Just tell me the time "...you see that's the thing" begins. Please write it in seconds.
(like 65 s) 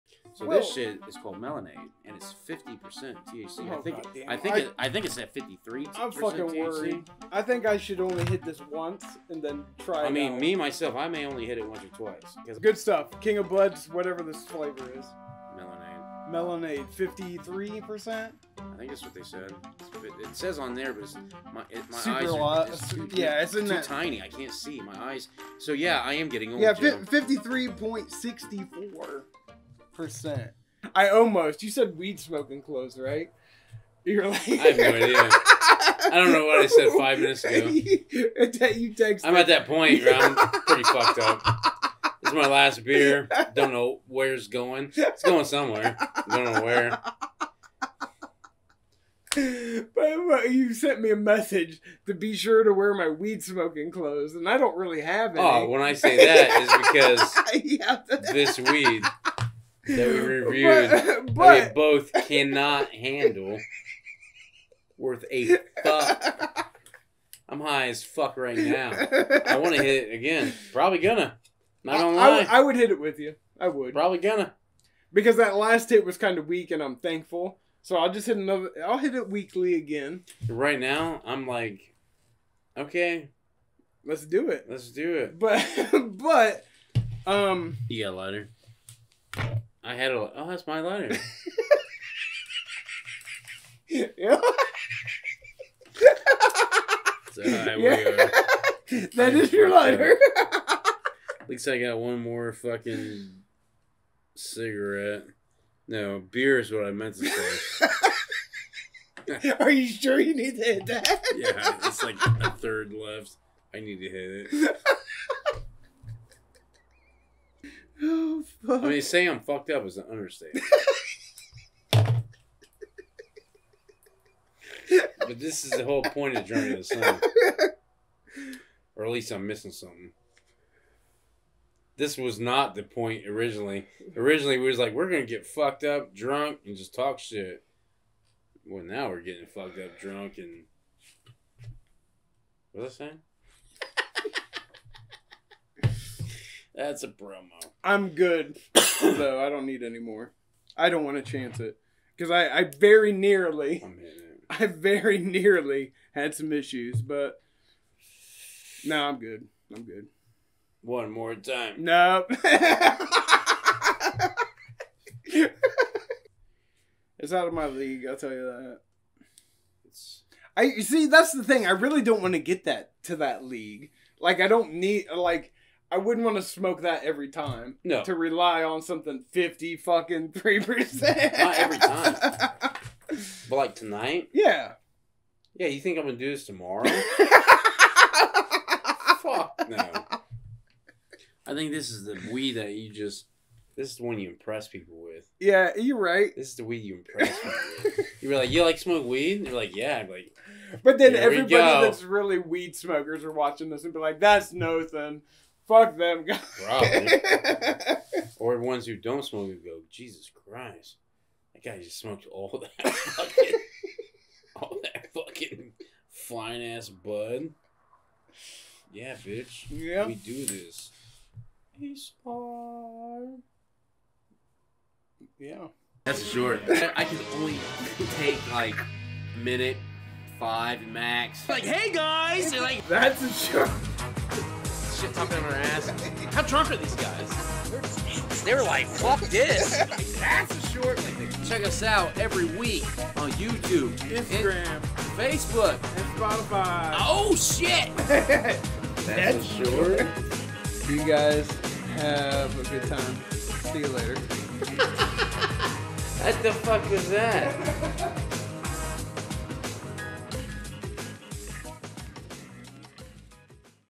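170 s.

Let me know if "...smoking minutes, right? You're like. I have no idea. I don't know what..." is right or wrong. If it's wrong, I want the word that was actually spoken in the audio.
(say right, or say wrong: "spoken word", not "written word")
wrong: "clothes", not "minutes".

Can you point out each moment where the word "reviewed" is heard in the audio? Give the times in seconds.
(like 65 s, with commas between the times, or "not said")
60 s.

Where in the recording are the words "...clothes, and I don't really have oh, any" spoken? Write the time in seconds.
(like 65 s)
53 s.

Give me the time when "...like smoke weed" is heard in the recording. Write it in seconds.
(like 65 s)
198 s.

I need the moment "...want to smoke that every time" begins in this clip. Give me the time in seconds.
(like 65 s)
176 s.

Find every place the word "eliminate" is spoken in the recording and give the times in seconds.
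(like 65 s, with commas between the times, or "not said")
not said.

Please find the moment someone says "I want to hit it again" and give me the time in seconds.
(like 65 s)
68 s.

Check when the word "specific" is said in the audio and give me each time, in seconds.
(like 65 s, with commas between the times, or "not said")
not said.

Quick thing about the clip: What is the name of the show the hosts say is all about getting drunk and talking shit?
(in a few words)
Drunk Under the Sun.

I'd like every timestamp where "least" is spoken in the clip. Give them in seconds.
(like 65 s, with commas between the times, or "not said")
101 s, 129 s.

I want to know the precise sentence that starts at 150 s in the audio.
I don't want to chance it because I, I very nearly, I very nearly had some issues, but no, nah, I'm good.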